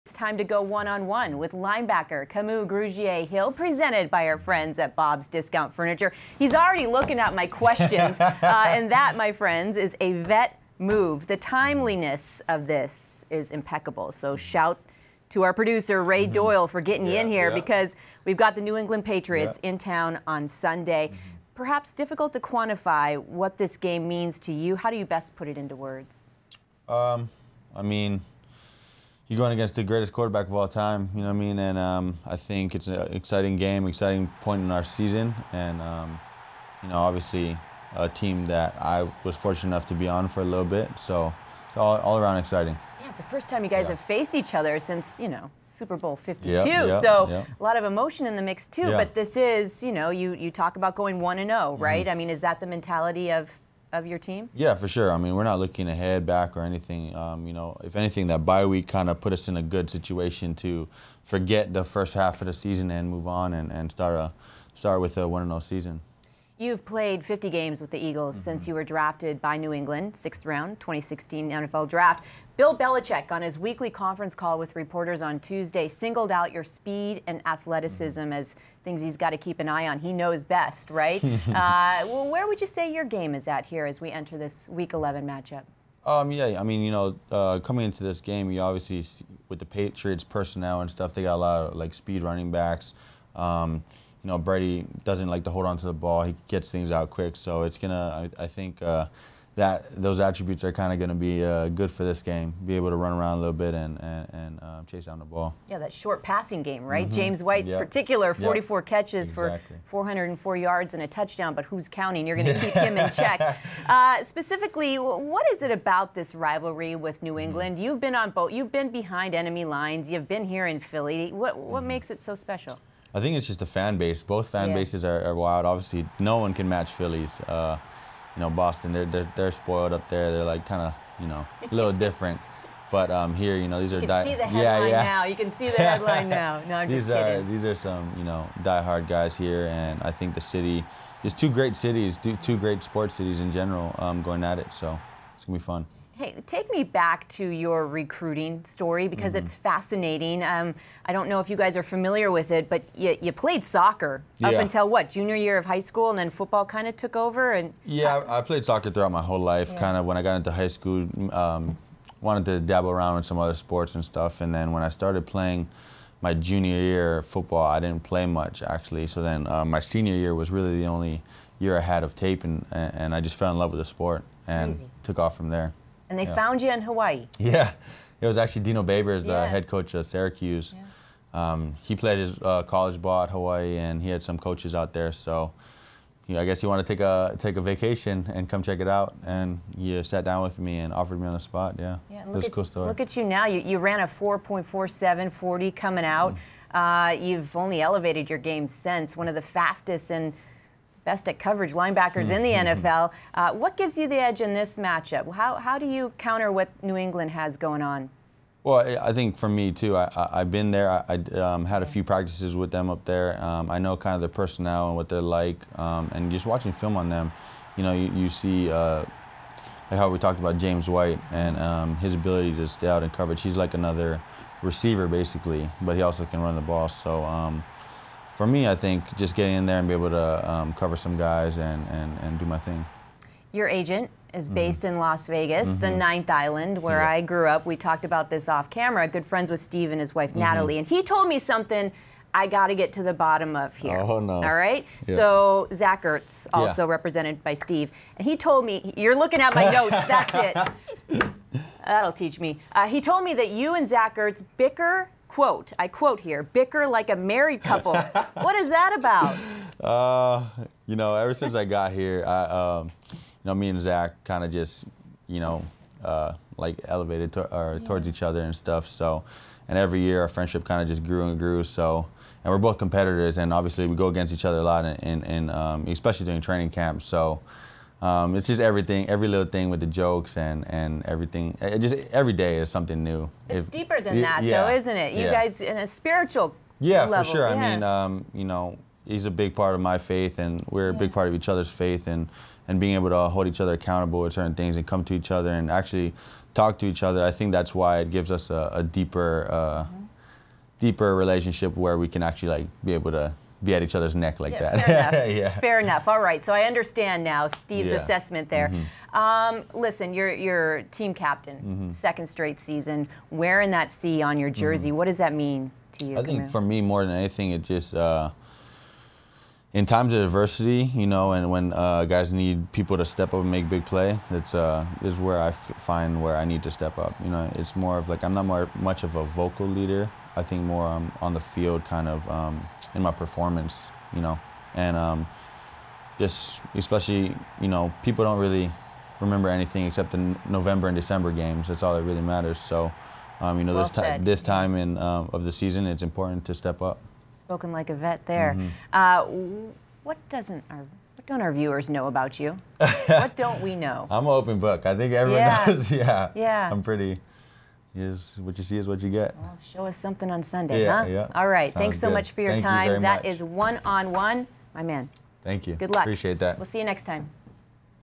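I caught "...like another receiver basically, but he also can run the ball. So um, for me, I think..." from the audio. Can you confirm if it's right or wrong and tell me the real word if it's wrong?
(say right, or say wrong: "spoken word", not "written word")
right.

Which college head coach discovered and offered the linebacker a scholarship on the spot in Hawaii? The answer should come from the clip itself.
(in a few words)
Dino Babers.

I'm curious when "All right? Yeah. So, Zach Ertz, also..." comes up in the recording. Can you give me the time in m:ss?
4:04.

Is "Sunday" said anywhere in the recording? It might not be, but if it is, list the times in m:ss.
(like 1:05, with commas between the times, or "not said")
0:20, 6:00.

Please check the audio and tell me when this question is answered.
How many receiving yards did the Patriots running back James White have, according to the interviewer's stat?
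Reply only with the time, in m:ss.
1:50.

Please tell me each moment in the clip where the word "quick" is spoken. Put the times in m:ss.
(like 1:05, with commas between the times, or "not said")
1:37.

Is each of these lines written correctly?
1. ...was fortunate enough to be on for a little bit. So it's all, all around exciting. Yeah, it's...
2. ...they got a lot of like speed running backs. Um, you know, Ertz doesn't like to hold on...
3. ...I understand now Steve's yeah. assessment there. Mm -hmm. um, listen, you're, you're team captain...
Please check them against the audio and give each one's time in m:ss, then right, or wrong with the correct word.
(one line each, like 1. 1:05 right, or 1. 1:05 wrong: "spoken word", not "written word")
1. 0:39 right
2. 1:31 wrong: "Brady", not "Ertz"
3. 5:06 right.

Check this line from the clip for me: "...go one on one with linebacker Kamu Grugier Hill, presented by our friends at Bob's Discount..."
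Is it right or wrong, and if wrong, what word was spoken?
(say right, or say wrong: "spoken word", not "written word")
right.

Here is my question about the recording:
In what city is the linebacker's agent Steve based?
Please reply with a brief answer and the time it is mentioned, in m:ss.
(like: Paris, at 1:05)
Las Vegas, at 3:54.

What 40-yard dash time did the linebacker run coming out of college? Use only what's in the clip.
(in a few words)
4.47.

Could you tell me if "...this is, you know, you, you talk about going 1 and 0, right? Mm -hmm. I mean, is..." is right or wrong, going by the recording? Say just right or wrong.
right.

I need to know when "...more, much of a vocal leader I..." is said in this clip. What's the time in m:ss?
5:28.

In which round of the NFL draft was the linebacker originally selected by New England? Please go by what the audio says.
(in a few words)
sixth round.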